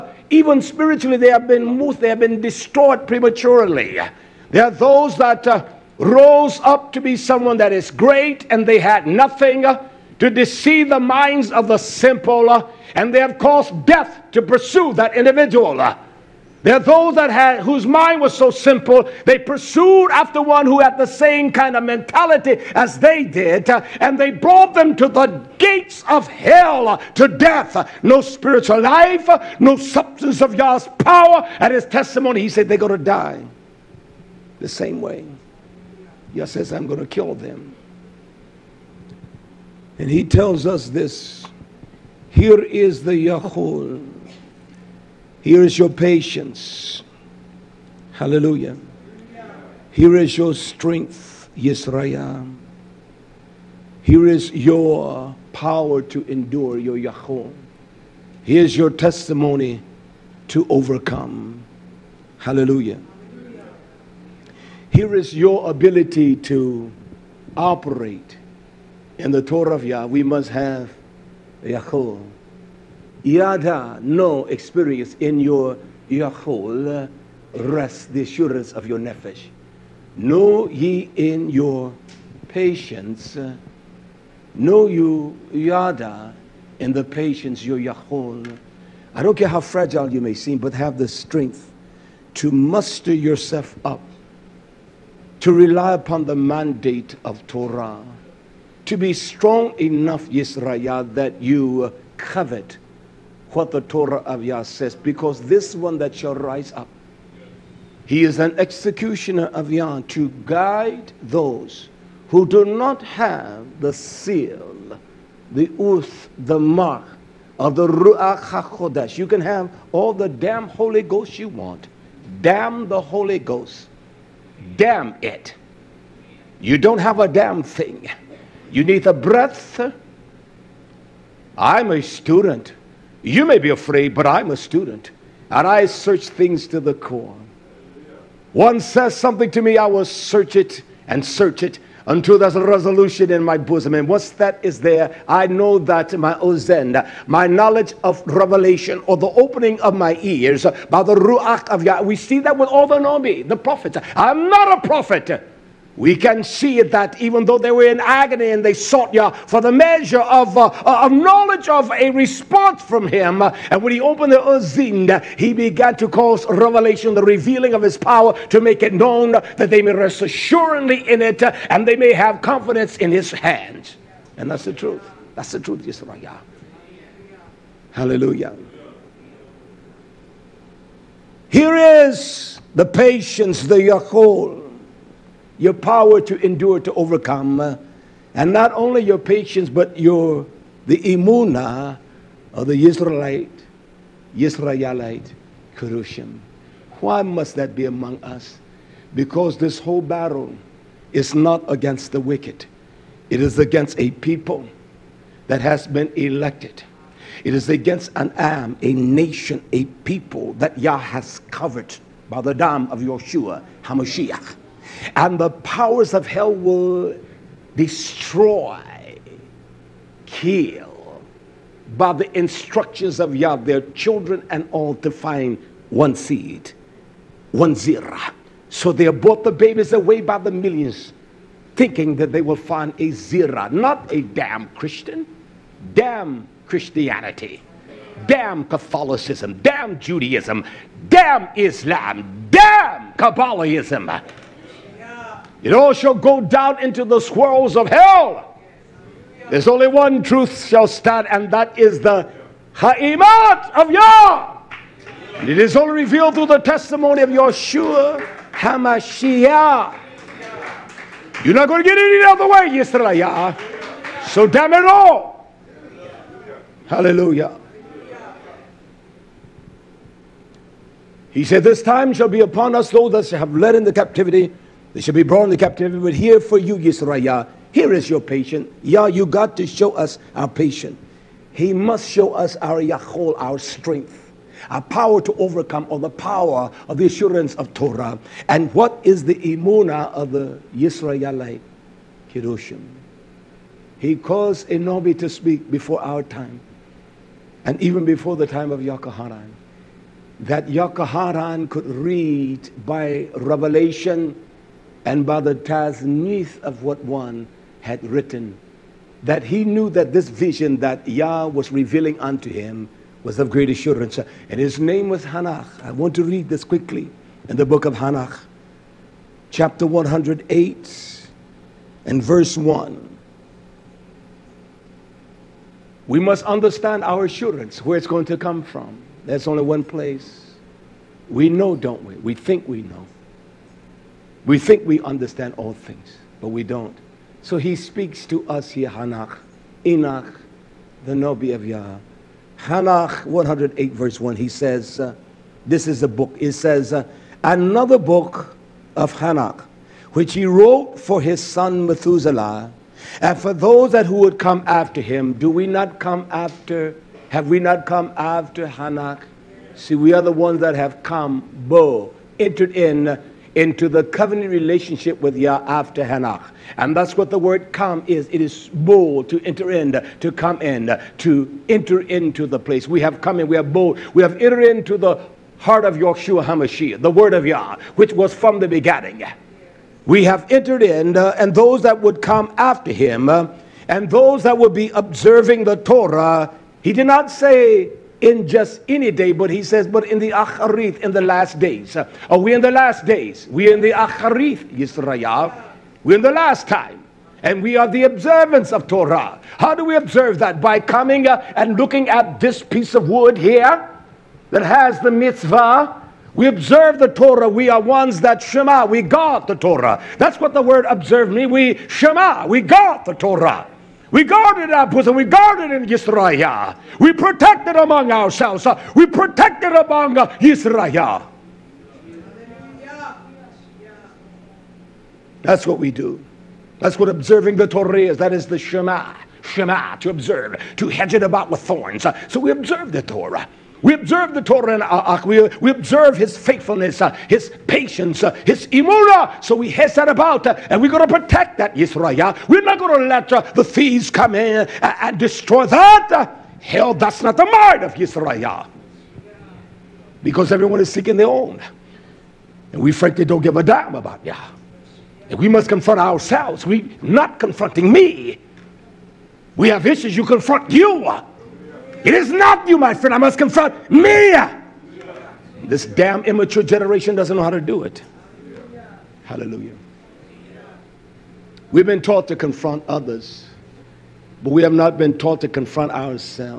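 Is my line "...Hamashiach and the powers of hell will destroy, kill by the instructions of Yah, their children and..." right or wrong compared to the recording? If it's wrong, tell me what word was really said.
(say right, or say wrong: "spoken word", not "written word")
right.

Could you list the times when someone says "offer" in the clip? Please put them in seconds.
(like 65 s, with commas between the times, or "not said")
not said.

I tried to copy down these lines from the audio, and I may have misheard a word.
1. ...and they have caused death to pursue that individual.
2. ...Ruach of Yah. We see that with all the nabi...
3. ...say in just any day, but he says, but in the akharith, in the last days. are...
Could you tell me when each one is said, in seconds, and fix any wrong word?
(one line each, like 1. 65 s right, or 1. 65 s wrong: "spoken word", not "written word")
1. 12 s right
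2. 151 s right
3. 387 s right.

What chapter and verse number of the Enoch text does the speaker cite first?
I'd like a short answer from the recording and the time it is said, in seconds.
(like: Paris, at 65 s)
108:1, at 319 s.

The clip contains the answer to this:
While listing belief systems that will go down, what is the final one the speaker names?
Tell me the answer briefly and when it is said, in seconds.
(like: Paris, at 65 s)
Kabbalahism, at 243 s.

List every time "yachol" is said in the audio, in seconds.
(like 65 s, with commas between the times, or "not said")
71 s, 76 s, 87 s, 282 s.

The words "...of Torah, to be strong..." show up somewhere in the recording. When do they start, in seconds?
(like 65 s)
97 s.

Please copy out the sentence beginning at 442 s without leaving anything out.
We're not going to let the thieves come in and destroy that.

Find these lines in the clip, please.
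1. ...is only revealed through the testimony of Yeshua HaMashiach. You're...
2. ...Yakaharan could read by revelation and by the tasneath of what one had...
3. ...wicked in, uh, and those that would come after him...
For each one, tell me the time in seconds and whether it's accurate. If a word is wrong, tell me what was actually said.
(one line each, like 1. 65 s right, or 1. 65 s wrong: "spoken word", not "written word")
1. 255 s right
2. 300 s right
3. 380 s wrong: "entered", not "wicked".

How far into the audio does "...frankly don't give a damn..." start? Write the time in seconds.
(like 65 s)
452 s.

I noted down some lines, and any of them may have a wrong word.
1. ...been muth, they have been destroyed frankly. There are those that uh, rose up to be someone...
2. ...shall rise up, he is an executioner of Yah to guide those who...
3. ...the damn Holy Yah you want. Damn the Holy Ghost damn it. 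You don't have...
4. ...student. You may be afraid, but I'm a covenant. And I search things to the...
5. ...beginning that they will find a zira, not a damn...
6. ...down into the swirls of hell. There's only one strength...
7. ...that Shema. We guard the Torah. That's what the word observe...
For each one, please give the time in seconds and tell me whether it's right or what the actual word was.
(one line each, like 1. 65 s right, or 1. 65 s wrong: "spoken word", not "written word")
1. 1 s wrong: "prematurely", not "frankly"
2. 106 s right
3. 120 s wrong: "Ghost", not "Yah"
4. 132 s wrong: "student", not "covenant"
5. 231 s wrong: "thinking", not "beginning"
6. 246 s wrong: "truth", not "strength"
7. 408 s right.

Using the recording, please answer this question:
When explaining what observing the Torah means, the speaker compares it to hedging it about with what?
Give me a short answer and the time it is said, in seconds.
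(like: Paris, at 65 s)
Thorns, at 431 s.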